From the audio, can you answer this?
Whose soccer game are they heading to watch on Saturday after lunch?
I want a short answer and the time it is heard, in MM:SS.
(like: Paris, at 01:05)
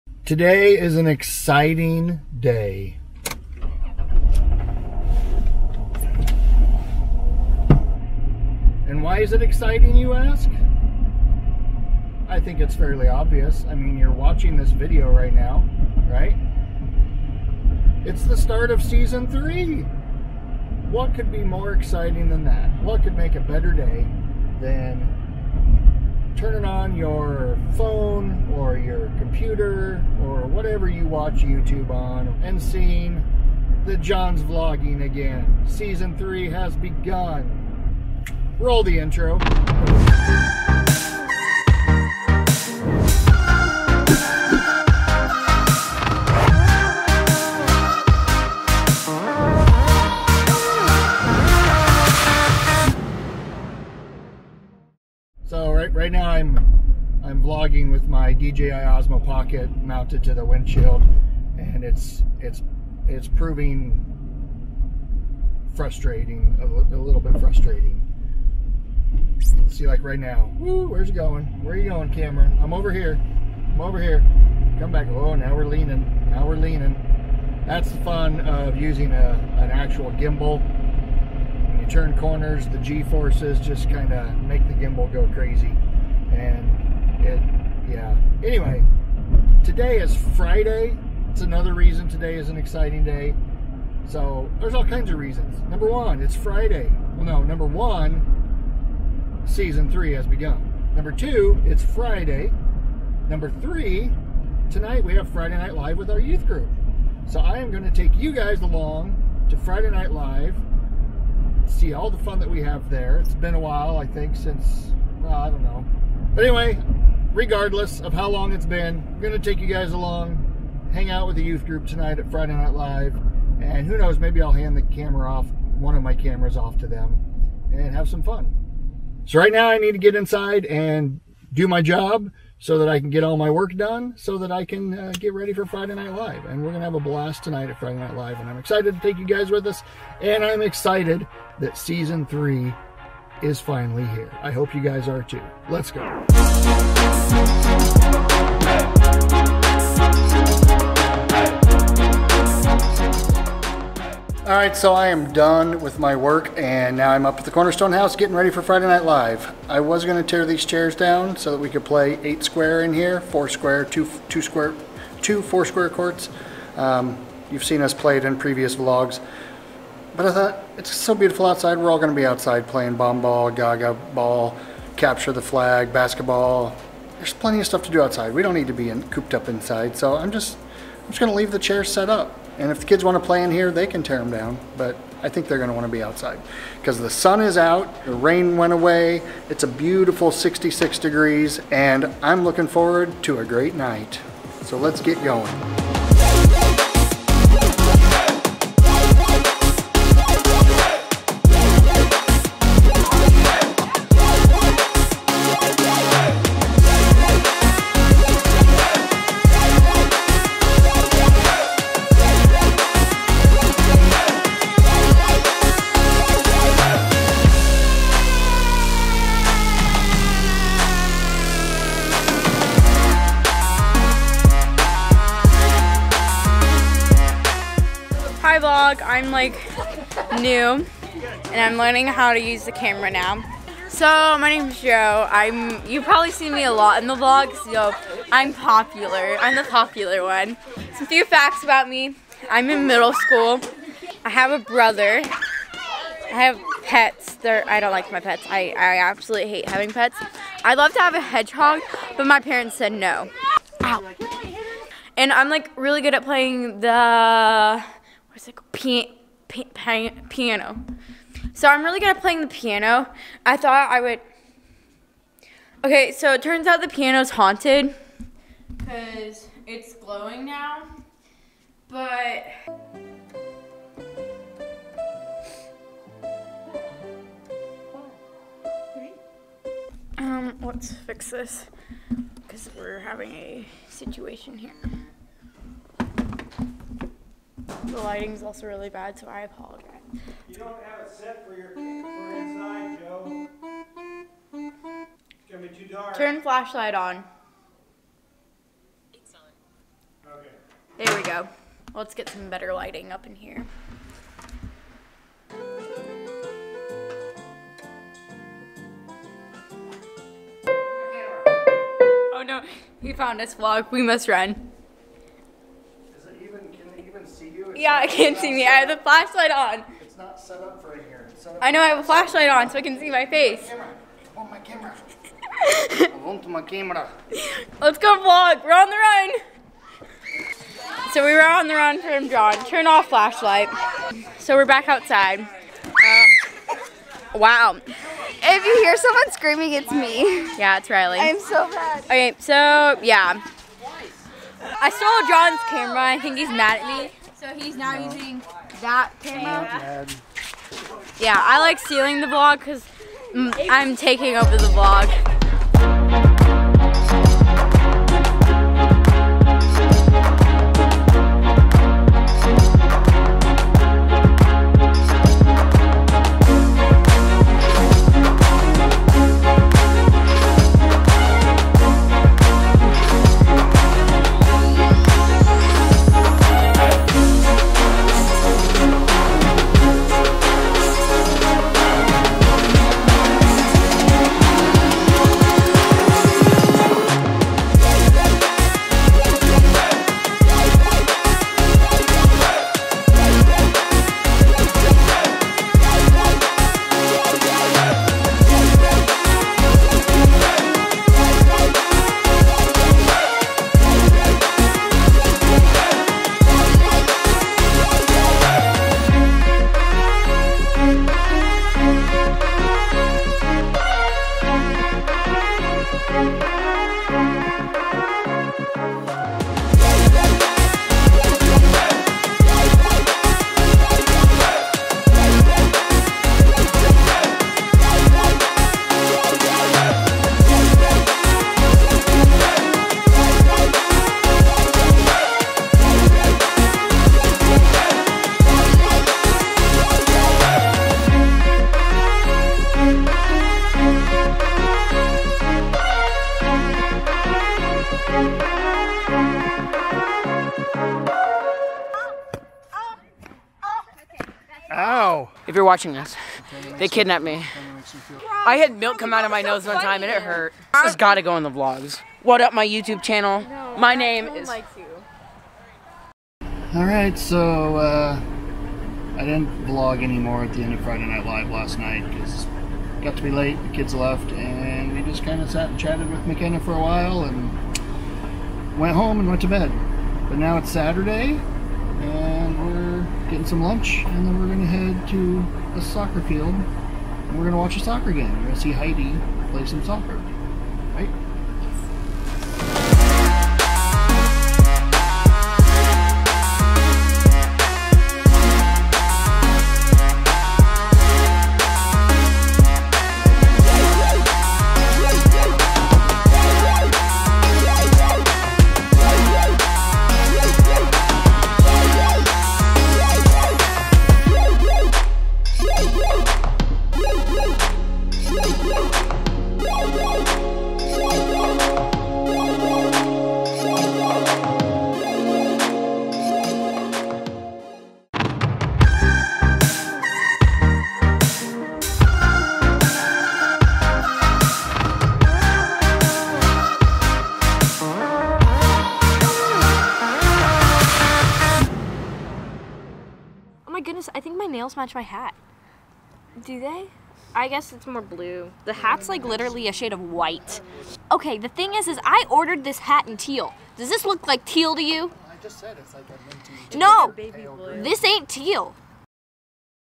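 Heidi, at 08:08.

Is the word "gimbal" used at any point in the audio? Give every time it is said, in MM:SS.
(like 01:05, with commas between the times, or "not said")
01:20, 01:24.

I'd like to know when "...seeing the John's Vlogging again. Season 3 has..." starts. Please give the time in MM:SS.
00:32.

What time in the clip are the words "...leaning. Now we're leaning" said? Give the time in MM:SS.
01:15.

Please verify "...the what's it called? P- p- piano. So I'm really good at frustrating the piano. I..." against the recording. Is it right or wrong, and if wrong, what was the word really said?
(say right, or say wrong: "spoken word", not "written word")
wrong: "playing", not "frustrating".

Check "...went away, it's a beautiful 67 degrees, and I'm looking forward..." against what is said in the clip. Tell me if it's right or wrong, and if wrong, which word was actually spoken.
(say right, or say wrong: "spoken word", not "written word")
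wrong: "66", not "67".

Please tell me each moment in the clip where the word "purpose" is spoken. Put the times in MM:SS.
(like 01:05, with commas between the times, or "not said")
not said.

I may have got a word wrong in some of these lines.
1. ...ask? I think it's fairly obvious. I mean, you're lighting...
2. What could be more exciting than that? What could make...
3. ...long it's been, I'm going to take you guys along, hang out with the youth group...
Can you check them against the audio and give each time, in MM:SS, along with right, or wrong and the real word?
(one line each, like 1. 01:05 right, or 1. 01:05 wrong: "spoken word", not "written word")
1. 00:10 wrong: "watching", not "lighting"
2. 00:20 right
3. 01:58 right.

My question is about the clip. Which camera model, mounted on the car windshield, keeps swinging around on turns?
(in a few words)
DJI Osmo Pocket.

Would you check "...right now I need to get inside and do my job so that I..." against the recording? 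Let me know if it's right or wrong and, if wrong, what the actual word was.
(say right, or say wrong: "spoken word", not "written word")
right.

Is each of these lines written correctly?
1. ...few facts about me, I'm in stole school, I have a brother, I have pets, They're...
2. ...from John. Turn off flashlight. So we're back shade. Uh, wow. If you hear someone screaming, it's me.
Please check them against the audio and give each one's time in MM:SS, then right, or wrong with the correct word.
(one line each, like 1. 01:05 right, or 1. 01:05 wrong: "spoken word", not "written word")
1. 04:01 wrong: "middle", not "stole"
2. 05:32 wrong: "outside", not "shade".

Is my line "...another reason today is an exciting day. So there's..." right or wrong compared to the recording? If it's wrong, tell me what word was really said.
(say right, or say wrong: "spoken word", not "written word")
right.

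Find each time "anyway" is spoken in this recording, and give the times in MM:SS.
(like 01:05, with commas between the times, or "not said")
01:28, 01:56.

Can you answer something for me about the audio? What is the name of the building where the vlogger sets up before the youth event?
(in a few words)
Cornerstone House.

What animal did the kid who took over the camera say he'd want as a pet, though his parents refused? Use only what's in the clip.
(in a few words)
A hedgehog.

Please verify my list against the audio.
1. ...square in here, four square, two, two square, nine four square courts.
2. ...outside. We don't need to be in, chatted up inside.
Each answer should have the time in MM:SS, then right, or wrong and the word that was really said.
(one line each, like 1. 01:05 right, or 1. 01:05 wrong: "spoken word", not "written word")
1. 02:42 wrong: "two", not "nine"
2. 02:58 wrong: "cooped", not "chatted".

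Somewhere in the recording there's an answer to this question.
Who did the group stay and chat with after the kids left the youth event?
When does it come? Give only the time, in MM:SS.
07:56.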